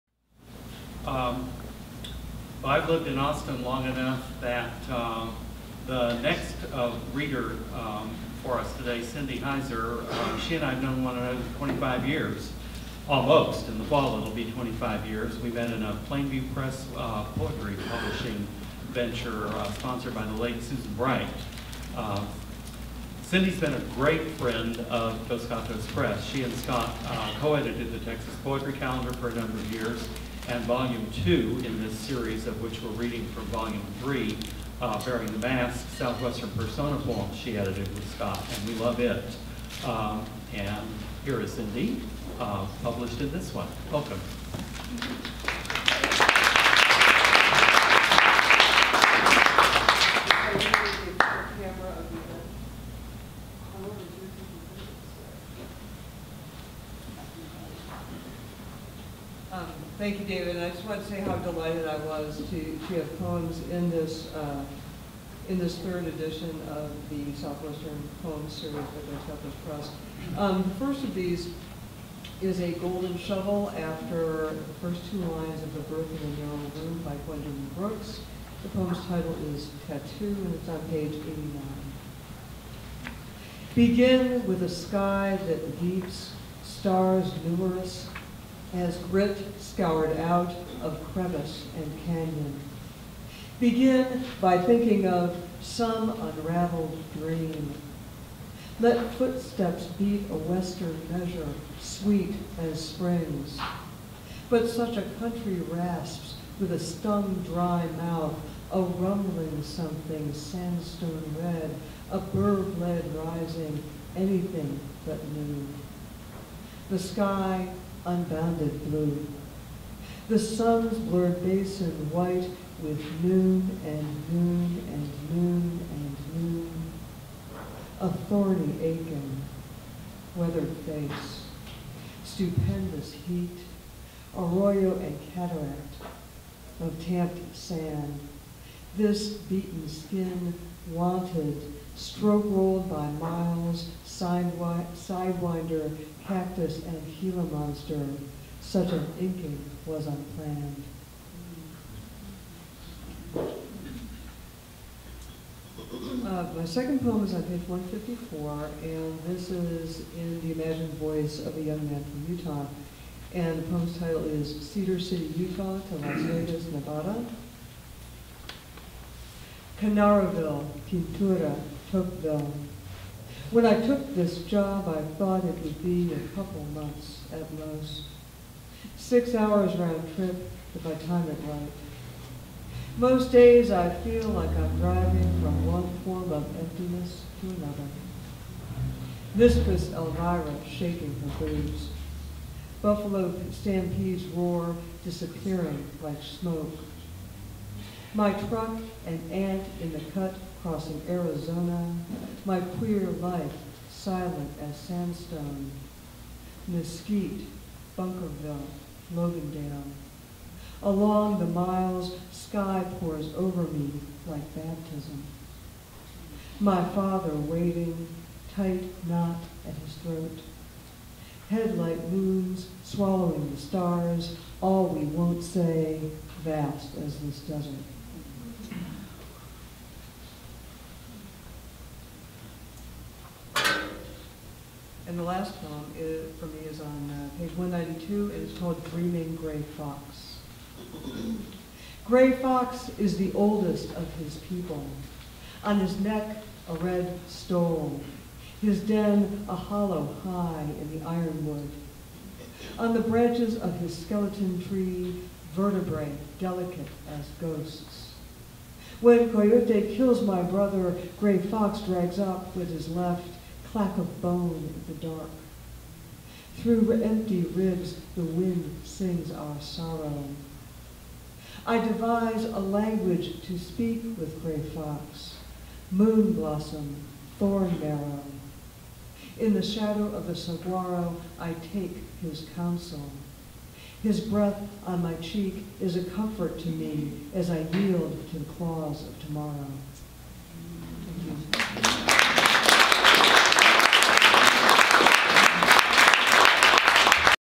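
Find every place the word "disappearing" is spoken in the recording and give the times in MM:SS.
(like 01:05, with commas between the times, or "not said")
03:15.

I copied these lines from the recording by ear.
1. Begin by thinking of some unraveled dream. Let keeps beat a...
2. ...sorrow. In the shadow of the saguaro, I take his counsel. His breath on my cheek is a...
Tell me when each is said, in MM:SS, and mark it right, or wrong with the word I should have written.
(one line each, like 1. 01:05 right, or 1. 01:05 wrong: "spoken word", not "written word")
1. 01:33 wrong: "footsteps", not "keeps"
2. 04:37 wrong: "marrow", not "sorrow".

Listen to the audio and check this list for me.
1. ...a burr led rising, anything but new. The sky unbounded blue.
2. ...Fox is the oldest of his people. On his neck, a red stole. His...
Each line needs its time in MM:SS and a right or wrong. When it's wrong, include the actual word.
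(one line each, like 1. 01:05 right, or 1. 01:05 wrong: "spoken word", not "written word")
1. 01:52 right
2. 04:02 right.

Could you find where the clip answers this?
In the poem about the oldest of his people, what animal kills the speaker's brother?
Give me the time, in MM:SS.
04:19.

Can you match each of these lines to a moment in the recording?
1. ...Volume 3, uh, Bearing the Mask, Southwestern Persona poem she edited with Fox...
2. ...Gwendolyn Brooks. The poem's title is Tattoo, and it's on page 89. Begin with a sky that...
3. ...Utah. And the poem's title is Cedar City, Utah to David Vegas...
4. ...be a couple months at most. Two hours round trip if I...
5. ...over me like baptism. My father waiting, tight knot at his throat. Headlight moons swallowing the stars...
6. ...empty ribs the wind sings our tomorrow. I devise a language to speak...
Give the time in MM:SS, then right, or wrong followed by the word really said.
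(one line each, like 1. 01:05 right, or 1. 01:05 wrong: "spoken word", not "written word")
1. 00:33 wrong: "Scott", not "Fox"
2. 01:17 right
3. 02:42 wrong: "Las", not "David"
4. 02:55 wrong: "Six", not "Two"
5. 03:33 right
6. 04:27 wrong: "sorrow", not "tomorrow".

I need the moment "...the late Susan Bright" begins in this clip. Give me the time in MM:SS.
00:20.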